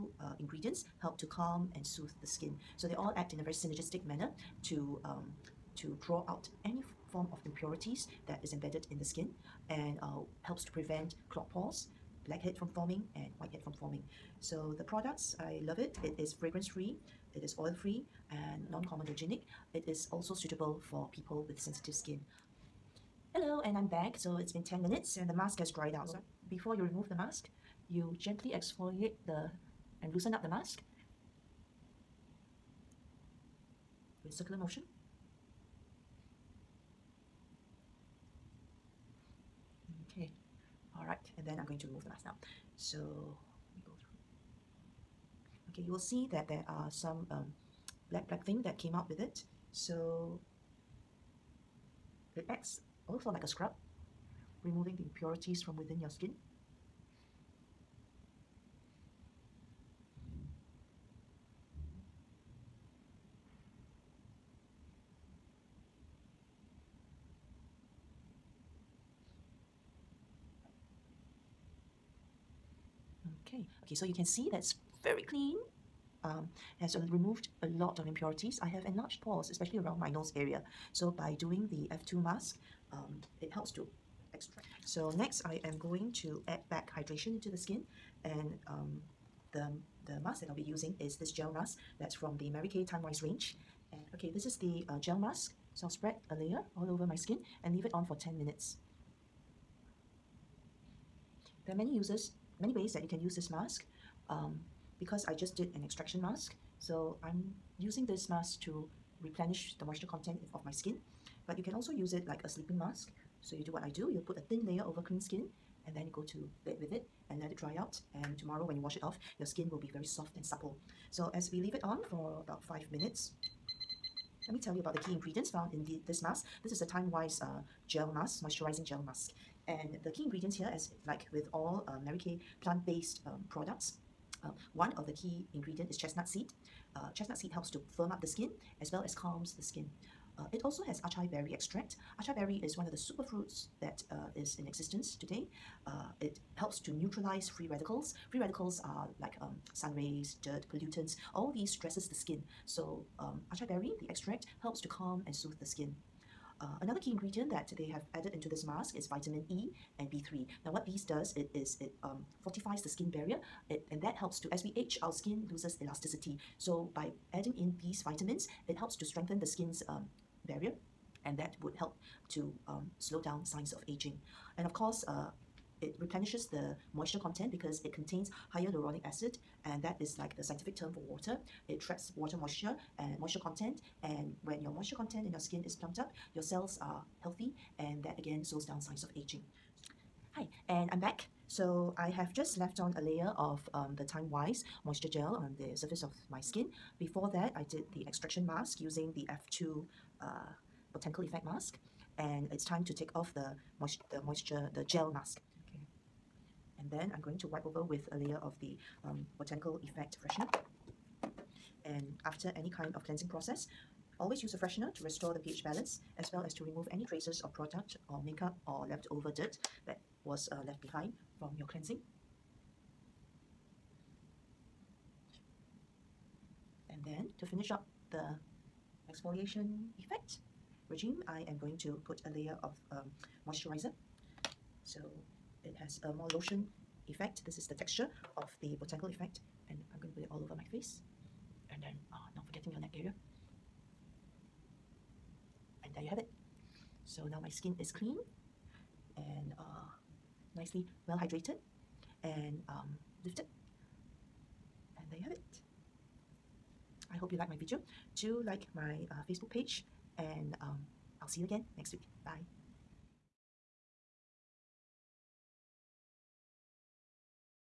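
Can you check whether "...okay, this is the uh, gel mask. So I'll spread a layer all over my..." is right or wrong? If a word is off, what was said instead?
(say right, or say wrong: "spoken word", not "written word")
right.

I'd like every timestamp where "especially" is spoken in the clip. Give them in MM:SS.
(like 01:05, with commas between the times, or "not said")
01:19.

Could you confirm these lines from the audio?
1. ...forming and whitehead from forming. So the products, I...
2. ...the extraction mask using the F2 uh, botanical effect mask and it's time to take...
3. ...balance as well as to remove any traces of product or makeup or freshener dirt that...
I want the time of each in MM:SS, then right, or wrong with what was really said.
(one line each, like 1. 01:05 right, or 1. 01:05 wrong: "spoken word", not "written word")
1. 00:12 right
2. 03:17 right
3. 03:35 wrong: "leftover", not "freshener".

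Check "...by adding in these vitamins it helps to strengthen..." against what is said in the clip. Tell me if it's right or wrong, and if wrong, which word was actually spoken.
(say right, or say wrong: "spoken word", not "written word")
right.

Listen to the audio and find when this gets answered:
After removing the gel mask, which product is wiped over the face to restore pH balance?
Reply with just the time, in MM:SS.
03:29.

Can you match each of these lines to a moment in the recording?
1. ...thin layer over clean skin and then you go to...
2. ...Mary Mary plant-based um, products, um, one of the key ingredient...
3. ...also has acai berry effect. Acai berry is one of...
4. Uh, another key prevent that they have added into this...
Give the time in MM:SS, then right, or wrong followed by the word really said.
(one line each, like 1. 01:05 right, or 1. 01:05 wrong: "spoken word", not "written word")
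1. 01:54 right
2. 02:12 wrong: "Kay", not "Mary"
3. 02:20 wrong: "extract", not "effect"
4. 02:36 wrong: "ingredient", not "prevent".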